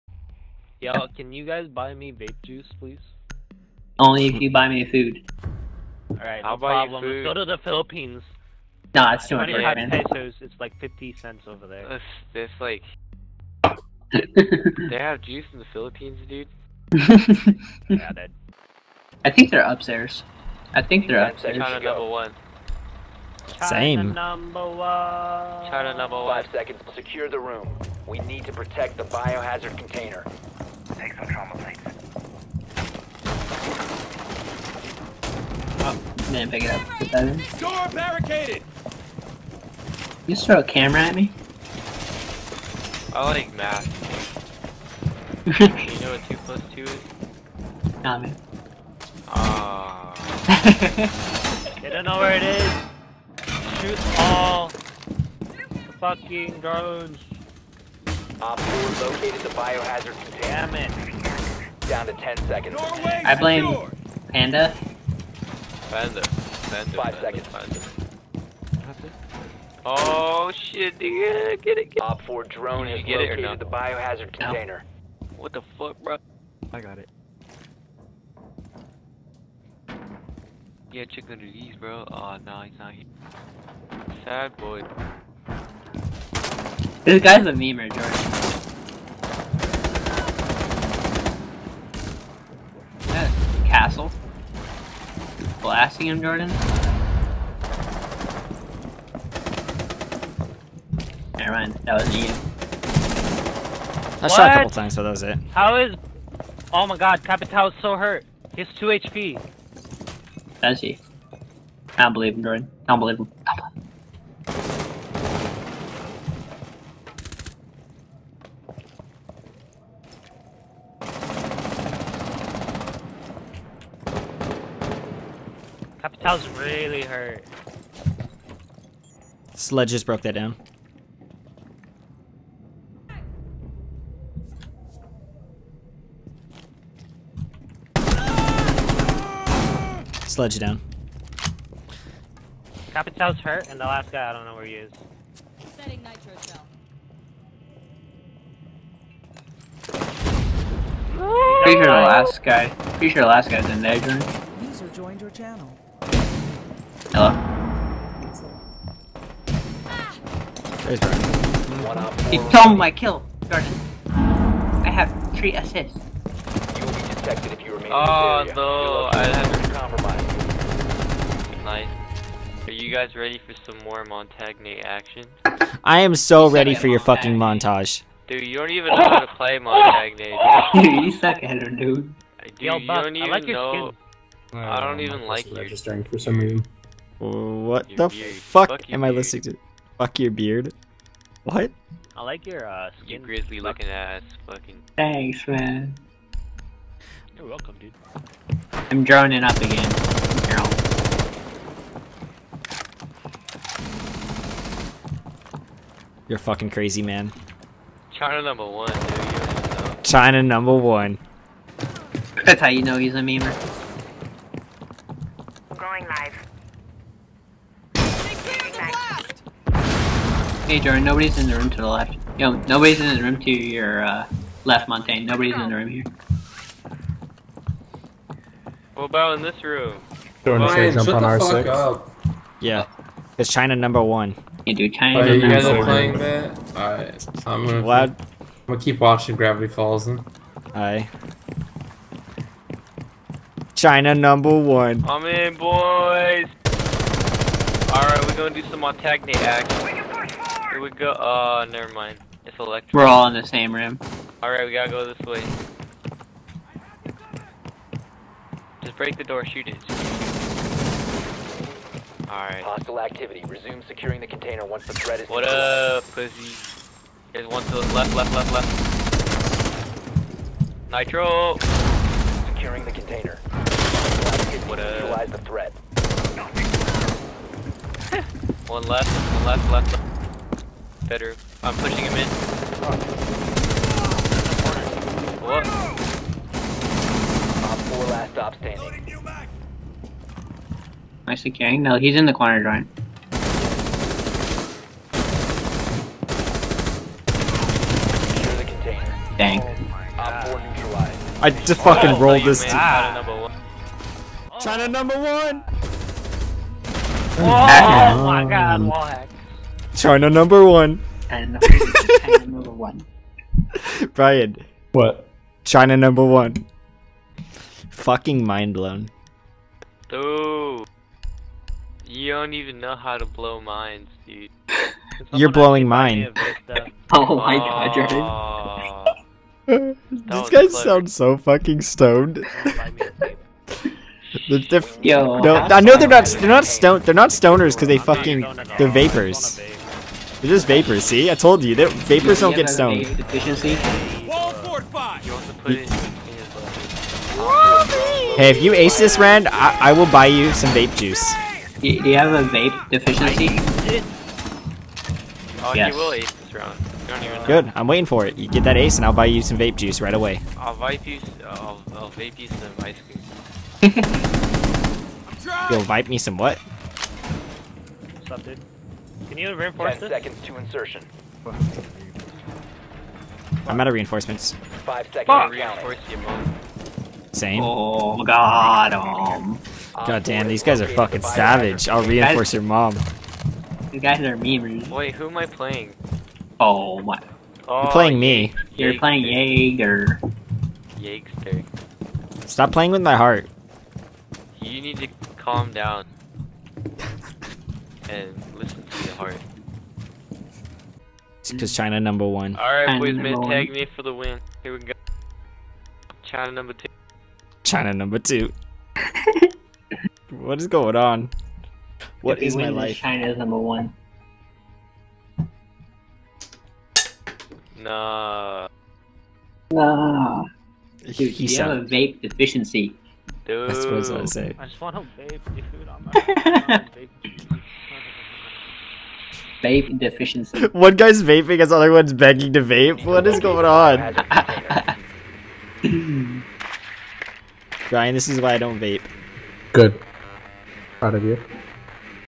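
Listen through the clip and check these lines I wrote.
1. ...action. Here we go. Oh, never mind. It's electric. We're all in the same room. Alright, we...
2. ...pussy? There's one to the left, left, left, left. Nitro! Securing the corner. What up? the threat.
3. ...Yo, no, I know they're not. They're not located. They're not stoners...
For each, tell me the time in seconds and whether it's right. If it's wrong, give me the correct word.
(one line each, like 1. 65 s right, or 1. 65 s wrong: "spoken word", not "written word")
1. 249 s right
2. 266 s wrong: "container", not "corner"
3. 335 s wrong: "stoned", not "located".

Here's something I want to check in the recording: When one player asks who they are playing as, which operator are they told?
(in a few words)
Jaeger.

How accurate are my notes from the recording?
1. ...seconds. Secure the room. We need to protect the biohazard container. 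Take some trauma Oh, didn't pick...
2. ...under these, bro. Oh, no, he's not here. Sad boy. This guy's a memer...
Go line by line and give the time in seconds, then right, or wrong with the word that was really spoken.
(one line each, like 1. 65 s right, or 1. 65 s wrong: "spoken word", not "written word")
1. 26 s right
2. 81 s right.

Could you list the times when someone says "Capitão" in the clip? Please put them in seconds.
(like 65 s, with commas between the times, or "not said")
126 s, 142 s.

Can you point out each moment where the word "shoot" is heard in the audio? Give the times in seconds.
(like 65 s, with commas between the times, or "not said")
53 s, 259 s.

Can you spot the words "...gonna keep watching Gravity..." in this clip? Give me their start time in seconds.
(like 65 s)
238 s.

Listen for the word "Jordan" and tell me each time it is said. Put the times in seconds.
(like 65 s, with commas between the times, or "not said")
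96 s, 112 s, 220 s, 230 s, 329 s.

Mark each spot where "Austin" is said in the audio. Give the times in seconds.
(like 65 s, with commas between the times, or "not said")
not said.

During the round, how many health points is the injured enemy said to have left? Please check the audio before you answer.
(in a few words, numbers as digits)
2.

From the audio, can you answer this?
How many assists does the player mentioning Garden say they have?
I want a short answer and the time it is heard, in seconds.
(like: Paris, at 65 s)
Three, at 164 s.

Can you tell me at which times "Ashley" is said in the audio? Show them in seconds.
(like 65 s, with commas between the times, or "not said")
not said.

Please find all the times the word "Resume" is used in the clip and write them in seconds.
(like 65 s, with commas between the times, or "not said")
263 s.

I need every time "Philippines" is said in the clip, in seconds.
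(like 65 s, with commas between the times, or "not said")
7 s, 15 s.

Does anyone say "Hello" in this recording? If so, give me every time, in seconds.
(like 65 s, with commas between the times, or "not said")
157 s.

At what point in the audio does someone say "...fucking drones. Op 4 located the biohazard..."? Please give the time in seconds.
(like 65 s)
55 s.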